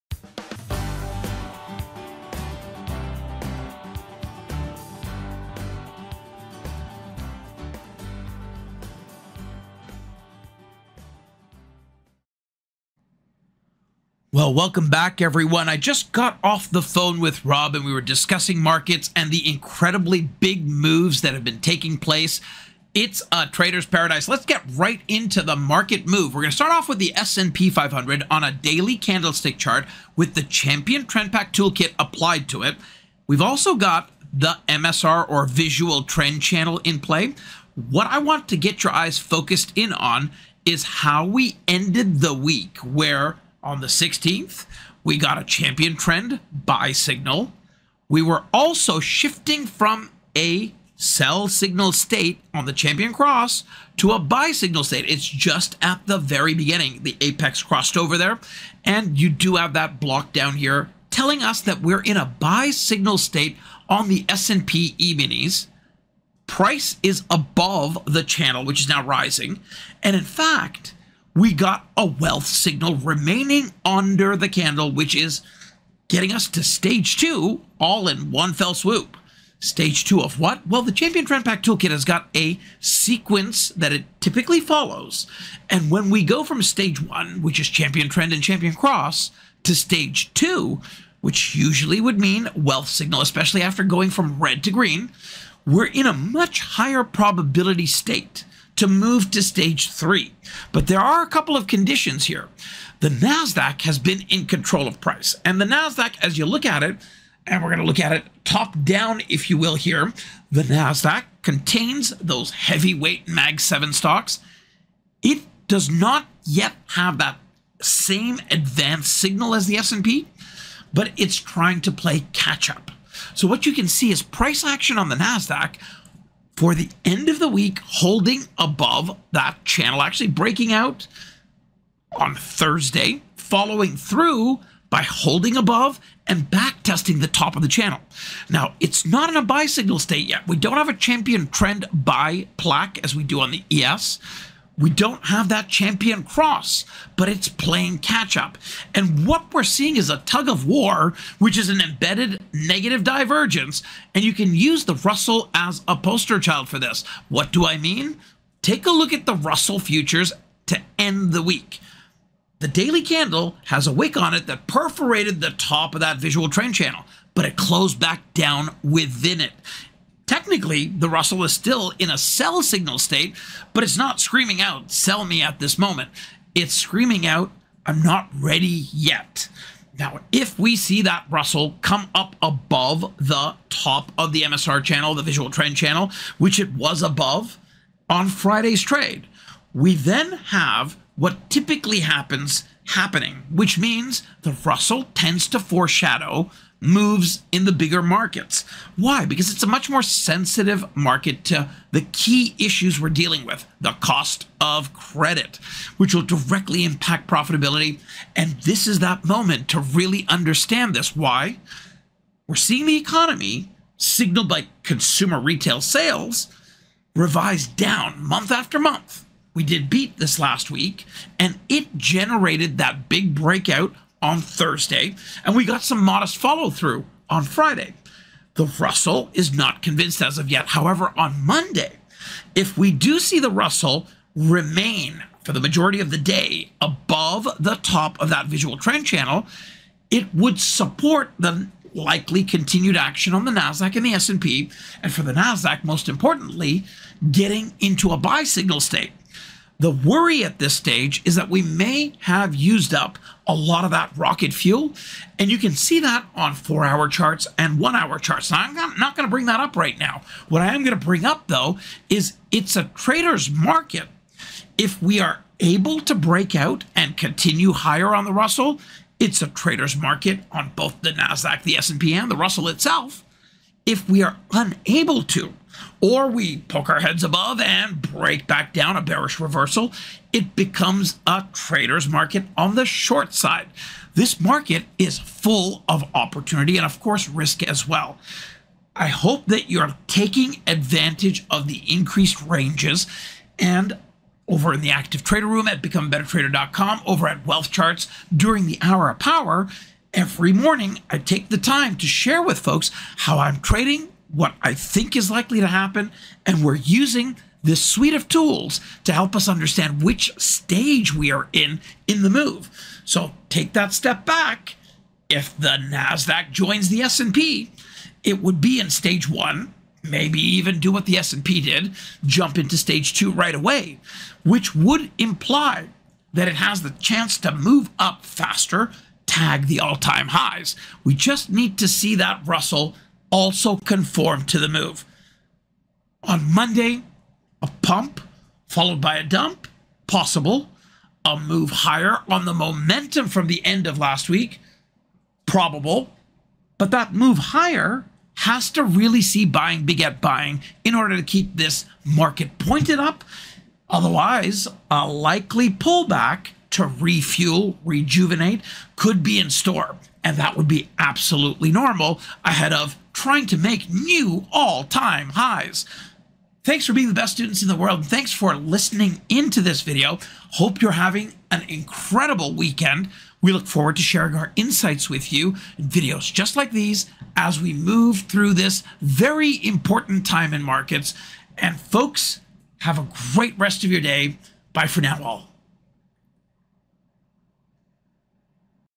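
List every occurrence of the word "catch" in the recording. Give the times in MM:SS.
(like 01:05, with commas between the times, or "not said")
02:02, 02:27.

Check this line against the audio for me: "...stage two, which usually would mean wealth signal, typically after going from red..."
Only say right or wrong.
wrong.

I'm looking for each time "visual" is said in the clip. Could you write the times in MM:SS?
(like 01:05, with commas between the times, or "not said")
00:35, 02:46, 03:05, 03:58.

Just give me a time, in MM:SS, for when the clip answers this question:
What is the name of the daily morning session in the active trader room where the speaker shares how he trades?
04:58.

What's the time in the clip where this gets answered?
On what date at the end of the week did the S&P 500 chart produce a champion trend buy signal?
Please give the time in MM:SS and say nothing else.
00:43.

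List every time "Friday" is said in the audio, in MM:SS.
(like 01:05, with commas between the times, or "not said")
03:08, 03:47.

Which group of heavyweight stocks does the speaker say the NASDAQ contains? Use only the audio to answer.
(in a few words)
MAG 7.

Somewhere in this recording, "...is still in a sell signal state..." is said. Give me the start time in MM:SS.
02:51.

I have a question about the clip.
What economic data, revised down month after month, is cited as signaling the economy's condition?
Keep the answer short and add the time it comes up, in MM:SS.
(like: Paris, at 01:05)
consumer retail sales, at 03:34.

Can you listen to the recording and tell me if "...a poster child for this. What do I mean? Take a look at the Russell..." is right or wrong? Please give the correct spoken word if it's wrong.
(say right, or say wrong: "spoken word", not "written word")
right.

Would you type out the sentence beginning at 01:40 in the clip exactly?
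But there are a couple of conditions here.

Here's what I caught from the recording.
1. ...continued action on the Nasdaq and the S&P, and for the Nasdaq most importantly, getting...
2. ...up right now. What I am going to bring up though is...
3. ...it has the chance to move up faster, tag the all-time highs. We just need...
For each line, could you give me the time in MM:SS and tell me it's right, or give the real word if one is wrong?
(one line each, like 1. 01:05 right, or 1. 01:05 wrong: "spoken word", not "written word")
1. 04:02 right
2. 04:19 right
3. 05:26 right.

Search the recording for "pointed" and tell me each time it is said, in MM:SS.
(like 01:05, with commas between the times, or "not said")
05:52.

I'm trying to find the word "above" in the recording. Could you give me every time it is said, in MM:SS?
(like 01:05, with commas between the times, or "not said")
01:07, 02:08, 02:15, 03:02, 03:07, 03:56, 04:37.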